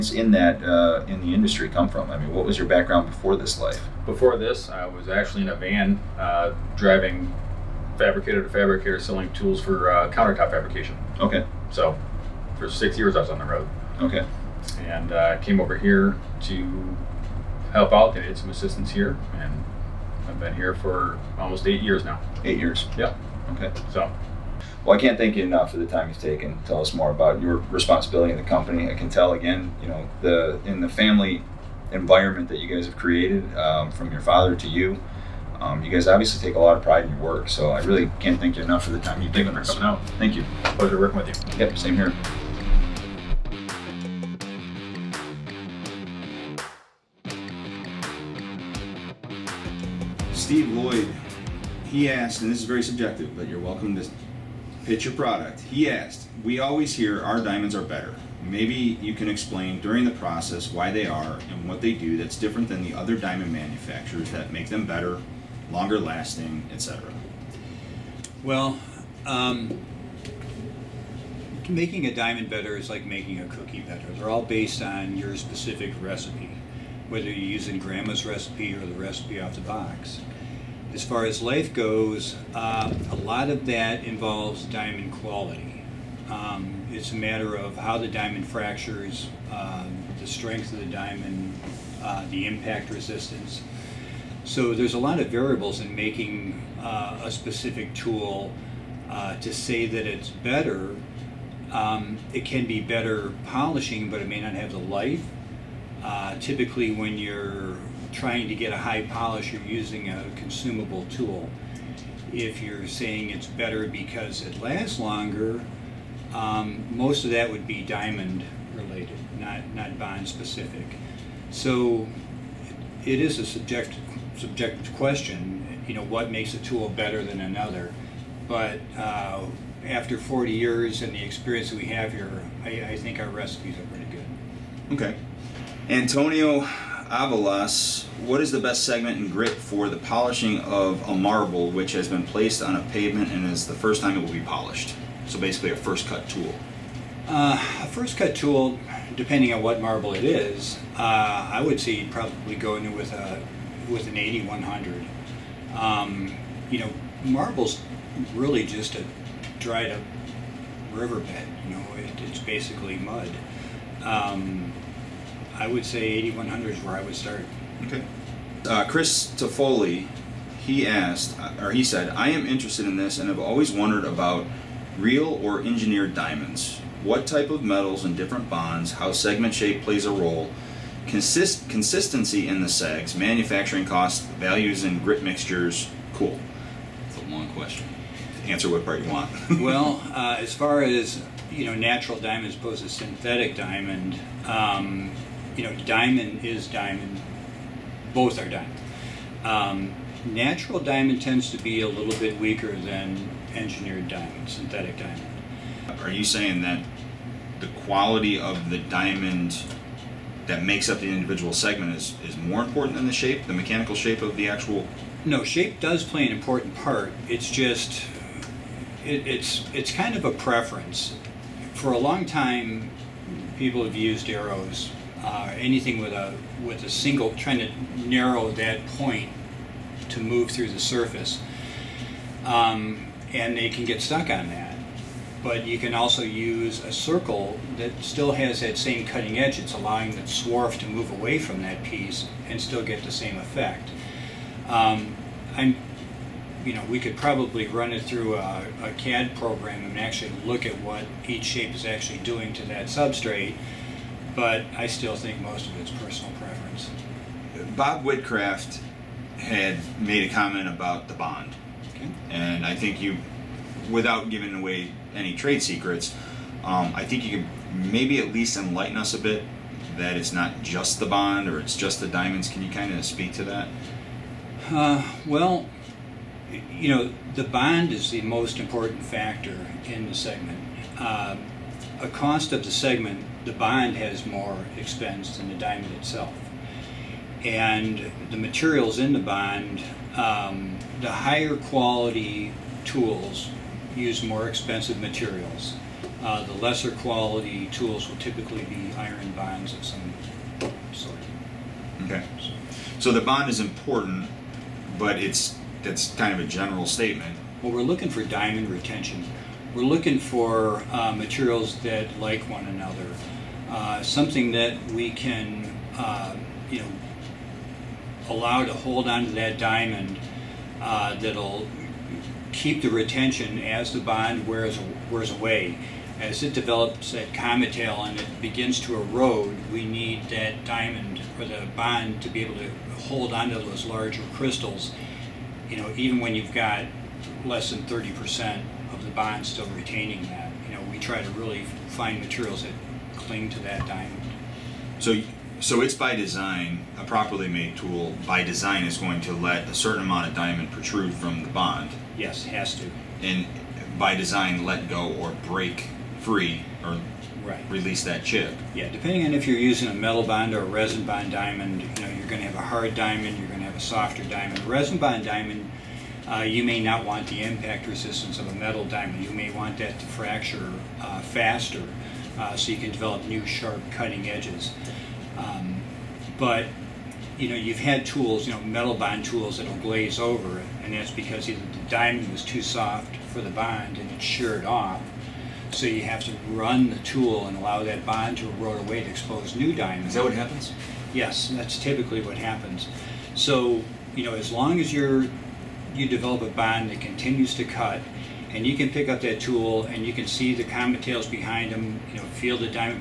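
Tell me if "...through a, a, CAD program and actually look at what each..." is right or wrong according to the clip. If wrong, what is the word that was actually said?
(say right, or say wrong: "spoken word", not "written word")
right.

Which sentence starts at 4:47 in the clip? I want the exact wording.
And the materials in the bond, um, the higher quality tools use more expensive materials.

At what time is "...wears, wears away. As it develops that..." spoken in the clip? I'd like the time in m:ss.
5:24.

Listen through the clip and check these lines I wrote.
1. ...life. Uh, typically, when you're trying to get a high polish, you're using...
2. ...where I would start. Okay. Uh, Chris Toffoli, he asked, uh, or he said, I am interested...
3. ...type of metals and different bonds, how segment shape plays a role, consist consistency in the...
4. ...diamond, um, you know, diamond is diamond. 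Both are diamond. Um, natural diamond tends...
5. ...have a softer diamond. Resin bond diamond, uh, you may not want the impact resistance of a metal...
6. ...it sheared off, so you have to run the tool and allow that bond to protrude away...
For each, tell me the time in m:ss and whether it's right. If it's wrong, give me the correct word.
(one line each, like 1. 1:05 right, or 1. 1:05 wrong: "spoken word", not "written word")
1. 1:44 right
2. 2:46 right
3. 2:57 right
4. 3:13 right
5. 6:03 right
6. 6:24 wrong: "erode", not "protrude".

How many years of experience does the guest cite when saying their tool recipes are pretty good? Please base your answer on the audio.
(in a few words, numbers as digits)
40.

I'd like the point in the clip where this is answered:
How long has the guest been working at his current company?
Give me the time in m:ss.
0:21.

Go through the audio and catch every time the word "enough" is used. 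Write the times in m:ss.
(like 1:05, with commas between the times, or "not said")
0:25, 0:38.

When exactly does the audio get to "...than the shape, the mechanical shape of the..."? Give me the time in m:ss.
3:32.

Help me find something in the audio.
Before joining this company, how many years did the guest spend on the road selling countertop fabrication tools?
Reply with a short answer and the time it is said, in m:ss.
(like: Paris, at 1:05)
6, at 0:12.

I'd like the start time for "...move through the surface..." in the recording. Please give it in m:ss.
3:50.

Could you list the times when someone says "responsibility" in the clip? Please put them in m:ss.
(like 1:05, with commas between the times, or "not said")
0:27.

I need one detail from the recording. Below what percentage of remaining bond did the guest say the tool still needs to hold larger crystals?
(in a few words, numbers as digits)
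30%.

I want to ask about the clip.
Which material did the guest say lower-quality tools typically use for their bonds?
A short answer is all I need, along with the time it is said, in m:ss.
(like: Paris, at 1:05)
iron, at 4:58.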